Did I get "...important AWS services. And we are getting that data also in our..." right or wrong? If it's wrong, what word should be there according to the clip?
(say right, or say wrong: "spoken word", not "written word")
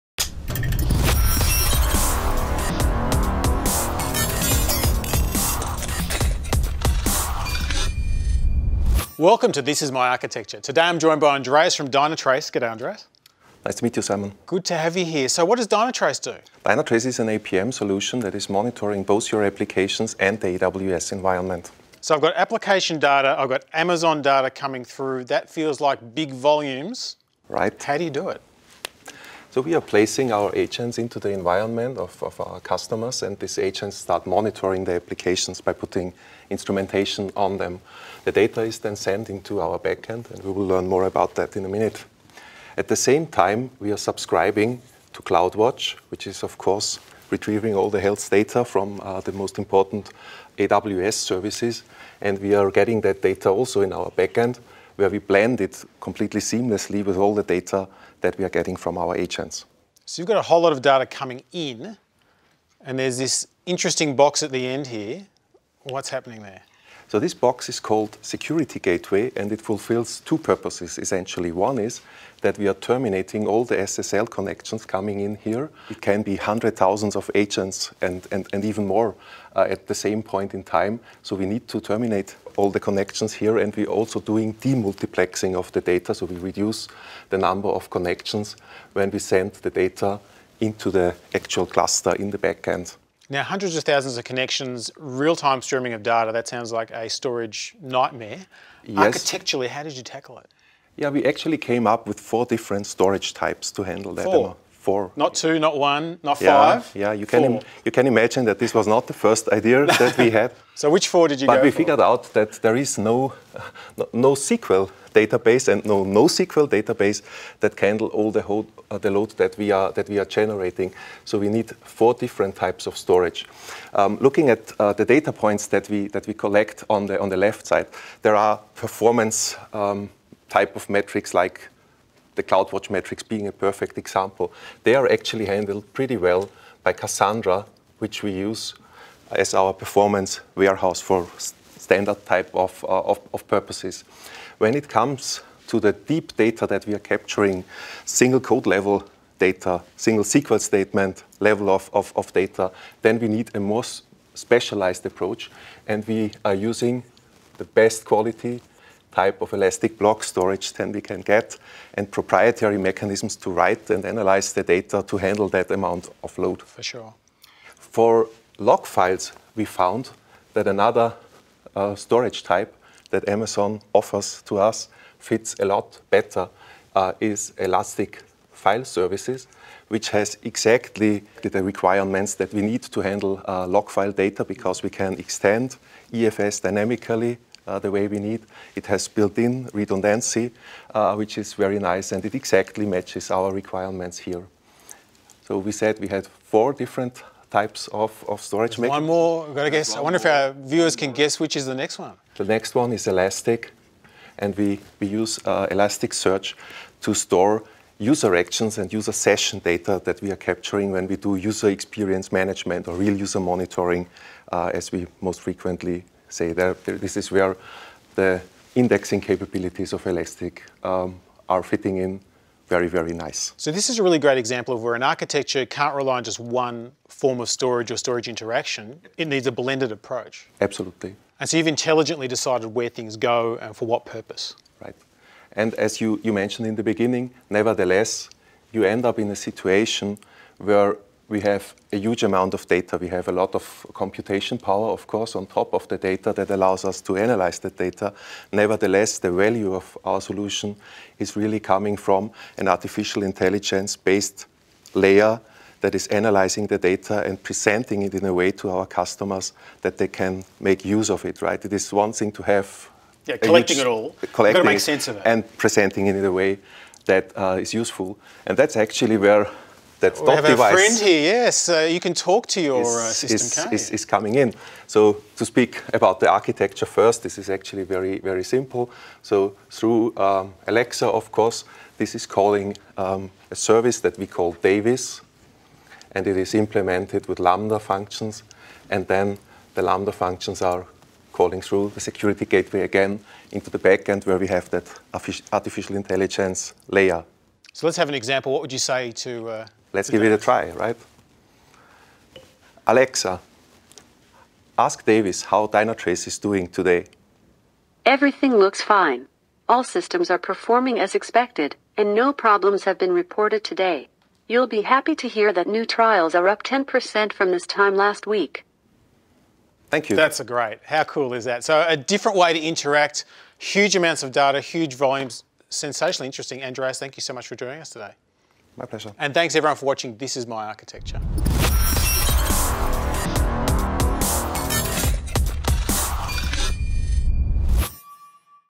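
right.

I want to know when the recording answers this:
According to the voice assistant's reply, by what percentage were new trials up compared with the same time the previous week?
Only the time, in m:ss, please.
5:16.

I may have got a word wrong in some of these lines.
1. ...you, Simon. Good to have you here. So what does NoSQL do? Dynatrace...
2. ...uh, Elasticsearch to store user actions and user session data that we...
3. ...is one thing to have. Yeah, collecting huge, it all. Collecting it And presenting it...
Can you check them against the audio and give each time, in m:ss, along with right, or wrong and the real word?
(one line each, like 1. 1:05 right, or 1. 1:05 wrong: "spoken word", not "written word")
1. 0:13 wrong: "Dynatrace", not "NoSQL"
2. 3:25 right
3. 4:21 right.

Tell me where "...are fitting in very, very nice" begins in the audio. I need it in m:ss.
3:41.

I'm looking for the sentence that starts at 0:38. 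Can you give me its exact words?
The data is then sent into our backend, and we will learn more about that in a minute.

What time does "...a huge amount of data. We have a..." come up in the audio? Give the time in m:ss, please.
4:01.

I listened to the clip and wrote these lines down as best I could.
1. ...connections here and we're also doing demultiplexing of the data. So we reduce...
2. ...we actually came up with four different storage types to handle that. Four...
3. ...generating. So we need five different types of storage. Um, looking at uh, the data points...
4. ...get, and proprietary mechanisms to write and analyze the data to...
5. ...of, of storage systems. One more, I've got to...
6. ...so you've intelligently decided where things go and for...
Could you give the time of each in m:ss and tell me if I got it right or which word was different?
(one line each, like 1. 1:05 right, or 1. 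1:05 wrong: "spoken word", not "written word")
1. 1:22 right
2. 1:41 right
3. 2:00 wrong: "four", not "five"
4. 2:41 right
5. 3:17 wrong: "mechanisms", not "systems"
6. 3:51 right.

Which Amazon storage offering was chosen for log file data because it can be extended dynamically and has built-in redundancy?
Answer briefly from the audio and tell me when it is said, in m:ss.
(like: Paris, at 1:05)
Elastic File Services, at 2:57.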